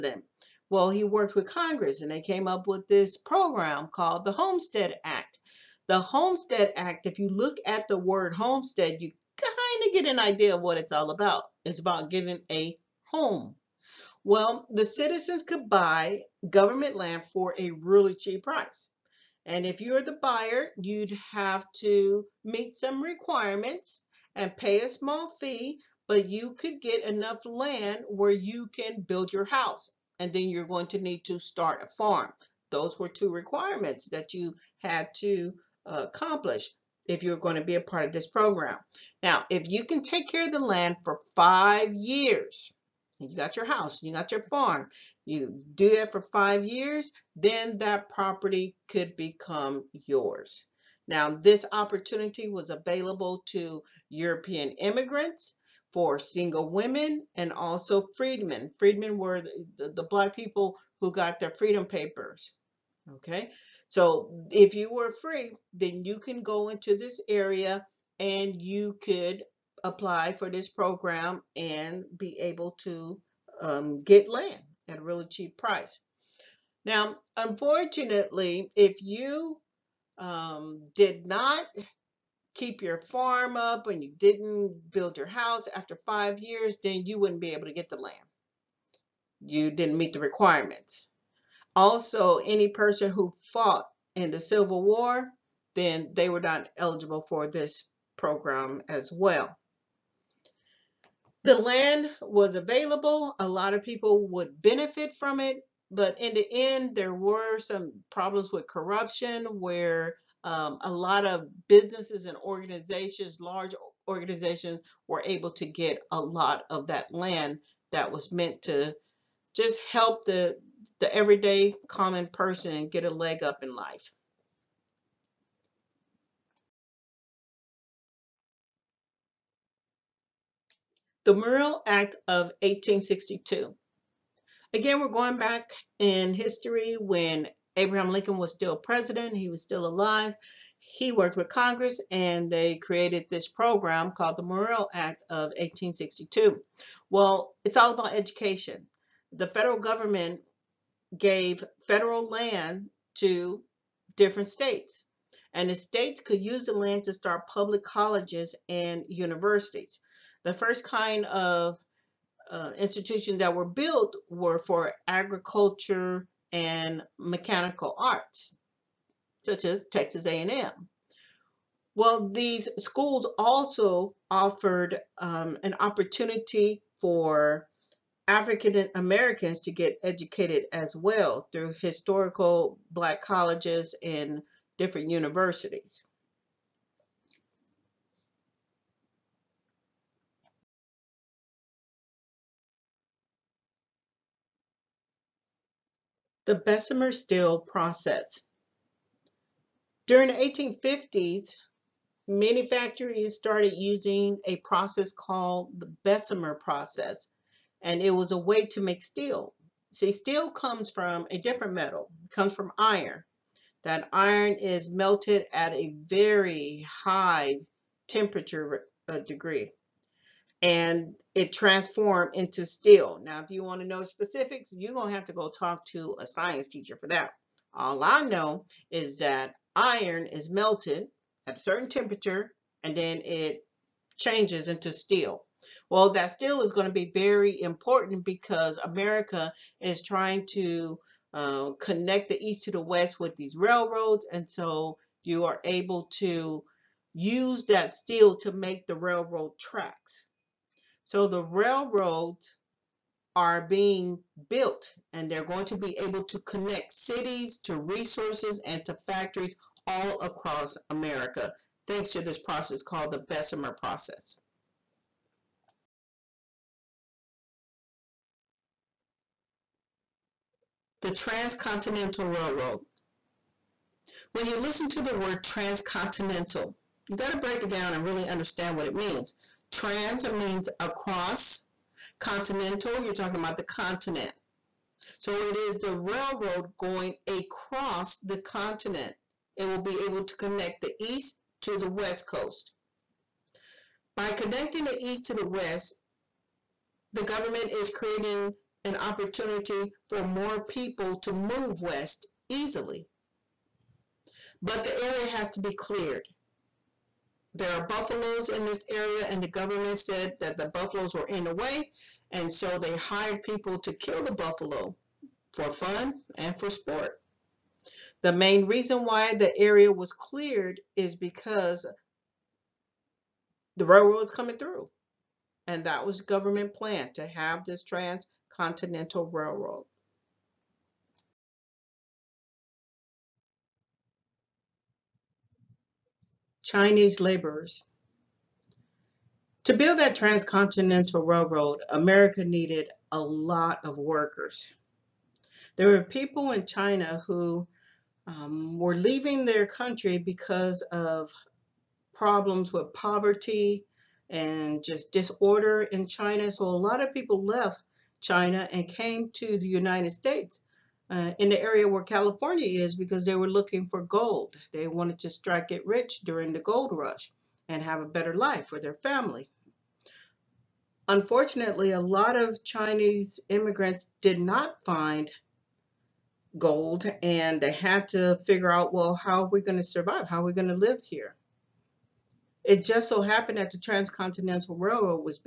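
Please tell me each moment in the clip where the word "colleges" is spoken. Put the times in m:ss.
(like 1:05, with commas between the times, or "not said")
2:37, 3:03.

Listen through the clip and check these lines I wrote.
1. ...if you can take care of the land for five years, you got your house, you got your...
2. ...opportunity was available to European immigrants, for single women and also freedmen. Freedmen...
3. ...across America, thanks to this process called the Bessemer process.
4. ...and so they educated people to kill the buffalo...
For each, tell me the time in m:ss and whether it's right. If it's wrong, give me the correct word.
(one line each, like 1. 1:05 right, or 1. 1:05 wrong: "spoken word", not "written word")
1. 0:39 right
2. 0:51 right
3. 4:20 right
4. 5:12 wrong: "hired", not "educated".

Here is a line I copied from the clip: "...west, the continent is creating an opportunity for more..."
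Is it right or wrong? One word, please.
wrong.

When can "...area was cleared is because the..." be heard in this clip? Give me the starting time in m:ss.
5:19.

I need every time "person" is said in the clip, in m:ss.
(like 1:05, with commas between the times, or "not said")
1:32, 2:02.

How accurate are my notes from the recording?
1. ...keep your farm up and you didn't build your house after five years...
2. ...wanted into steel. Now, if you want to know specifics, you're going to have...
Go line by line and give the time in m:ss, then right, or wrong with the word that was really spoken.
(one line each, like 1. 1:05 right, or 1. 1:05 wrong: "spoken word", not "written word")
1. 1:22 right
2. 3:41 wrong: "transformed", not "wanted".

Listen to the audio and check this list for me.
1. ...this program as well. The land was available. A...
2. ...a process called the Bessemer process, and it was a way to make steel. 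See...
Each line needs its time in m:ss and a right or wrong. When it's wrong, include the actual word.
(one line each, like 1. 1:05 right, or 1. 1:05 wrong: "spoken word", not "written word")
1. 1:37 right
2. 3:24 right.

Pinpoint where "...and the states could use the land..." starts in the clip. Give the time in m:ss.
2:35.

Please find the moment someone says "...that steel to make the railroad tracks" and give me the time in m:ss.
4:07.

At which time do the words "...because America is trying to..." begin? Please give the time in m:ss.
3:58.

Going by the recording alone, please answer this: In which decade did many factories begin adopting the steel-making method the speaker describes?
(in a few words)
1850s.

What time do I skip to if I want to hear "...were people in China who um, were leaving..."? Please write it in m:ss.
5:45.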